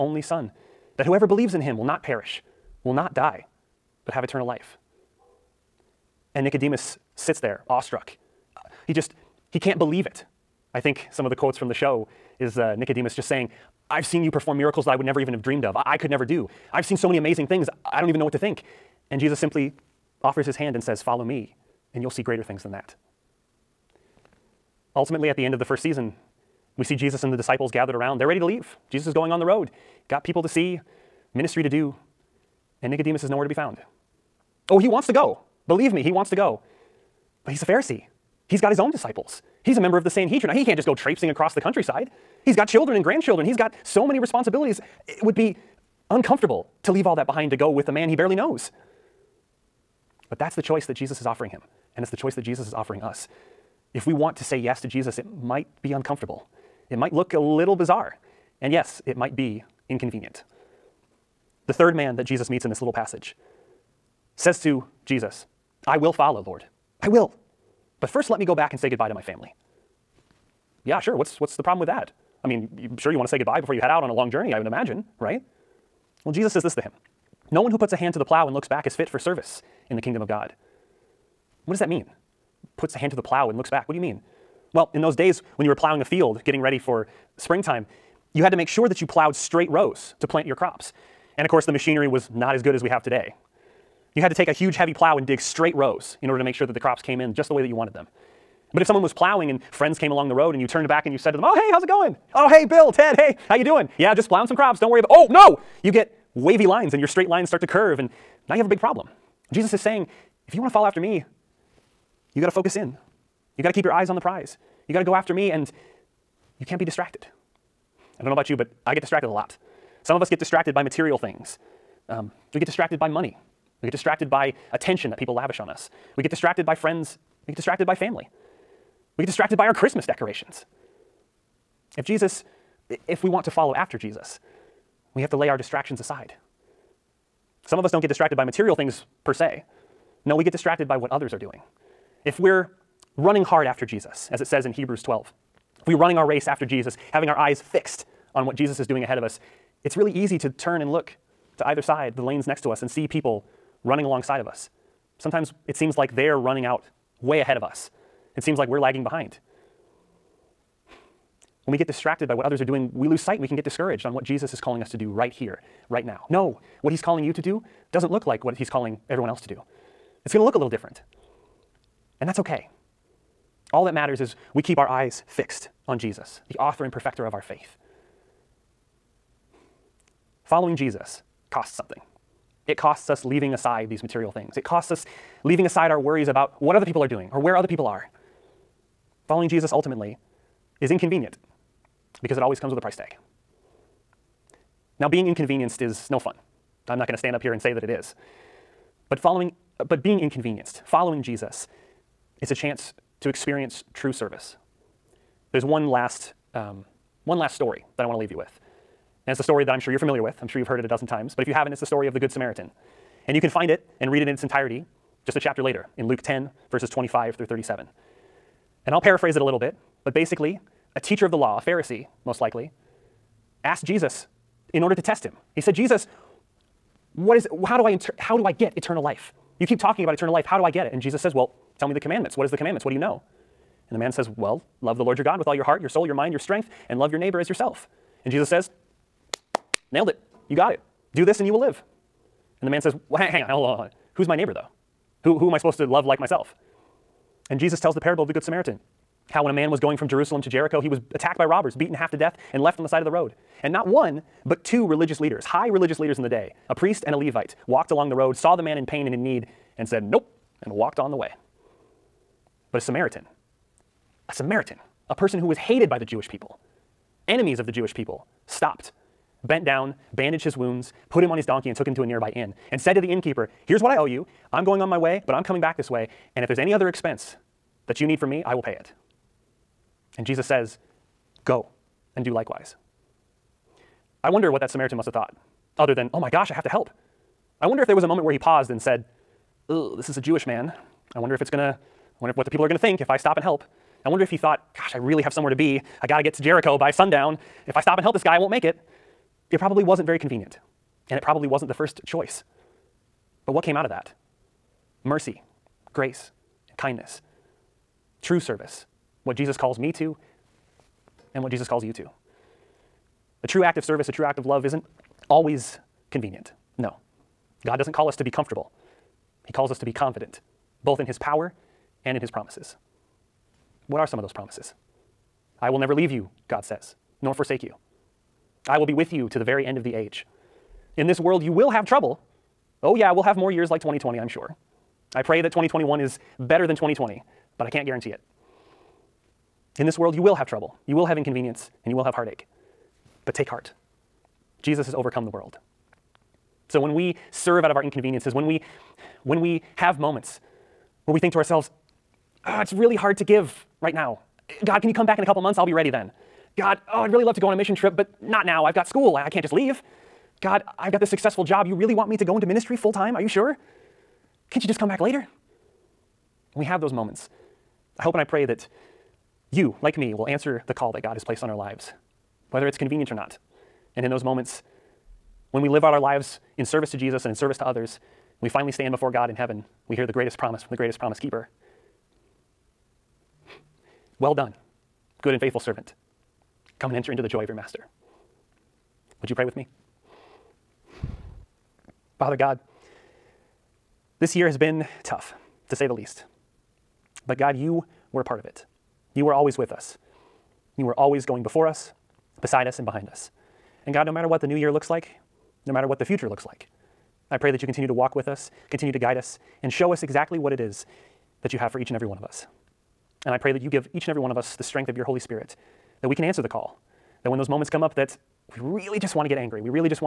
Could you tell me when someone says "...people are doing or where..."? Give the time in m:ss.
3:06.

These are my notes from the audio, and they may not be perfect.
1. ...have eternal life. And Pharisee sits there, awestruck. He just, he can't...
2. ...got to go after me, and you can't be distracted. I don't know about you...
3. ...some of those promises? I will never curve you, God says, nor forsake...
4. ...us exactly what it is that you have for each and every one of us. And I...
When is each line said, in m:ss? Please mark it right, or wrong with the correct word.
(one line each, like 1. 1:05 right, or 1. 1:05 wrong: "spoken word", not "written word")
1. 0:04 wrong: "Nicodemus", not "Pharisee"
2. 1:54 right
3. 5:24 wrong: "leave", not "curve"
4. 6:49 right.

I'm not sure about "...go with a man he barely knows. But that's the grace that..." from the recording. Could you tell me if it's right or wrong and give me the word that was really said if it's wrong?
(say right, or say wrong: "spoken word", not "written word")
wrong: "choice", not "grace".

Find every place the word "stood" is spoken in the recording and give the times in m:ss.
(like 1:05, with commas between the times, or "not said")
not said.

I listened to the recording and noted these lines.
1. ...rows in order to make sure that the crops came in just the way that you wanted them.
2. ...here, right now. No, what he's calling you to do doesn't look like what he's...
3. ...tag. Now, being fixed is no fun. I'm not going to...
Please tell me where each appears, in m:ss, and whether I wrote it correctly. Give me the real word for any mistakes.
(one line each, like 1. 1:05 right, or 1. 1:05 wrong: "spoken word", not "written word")
1. 1:35 right
2. 2:45 right
3. 3:12 wrong: "inconvenienced", not "fixed".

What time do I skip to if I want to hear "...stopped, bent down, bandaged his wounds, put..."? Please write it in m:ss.
4:28.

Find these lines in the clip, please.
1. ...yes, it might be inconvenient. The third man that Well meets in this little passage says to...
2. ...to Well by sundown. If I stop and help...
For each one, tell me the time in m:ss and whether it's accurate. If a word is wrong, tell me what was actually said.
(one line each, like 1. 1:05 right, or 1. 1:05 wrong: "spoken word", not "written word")
1. 0:58 wrong: "Jesus", not "Well"
2. 4:56 wrong: "Jericho", not "Well".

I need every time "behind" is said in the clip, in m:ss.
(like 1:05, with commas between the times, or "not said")
0:47, 2:39, 6:42.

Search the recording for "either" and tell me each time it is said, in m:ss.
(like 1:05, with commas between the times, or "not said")
2:31.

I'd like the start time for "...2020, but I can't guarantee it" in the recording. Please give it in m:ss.
5:36.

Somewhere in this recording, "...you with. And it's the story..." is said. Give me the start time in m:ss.
3:28.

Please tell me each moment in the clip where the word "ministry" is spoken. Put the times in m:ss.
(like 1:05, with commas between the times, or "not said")
0:31, 6:02.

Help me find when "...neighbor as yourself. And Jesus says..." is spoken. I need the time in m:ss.
3:57.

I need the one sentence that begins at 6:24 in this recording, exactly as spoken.
Well done, good and faithful servant.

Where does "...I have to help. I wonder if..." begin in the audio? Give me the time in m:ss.
4:46.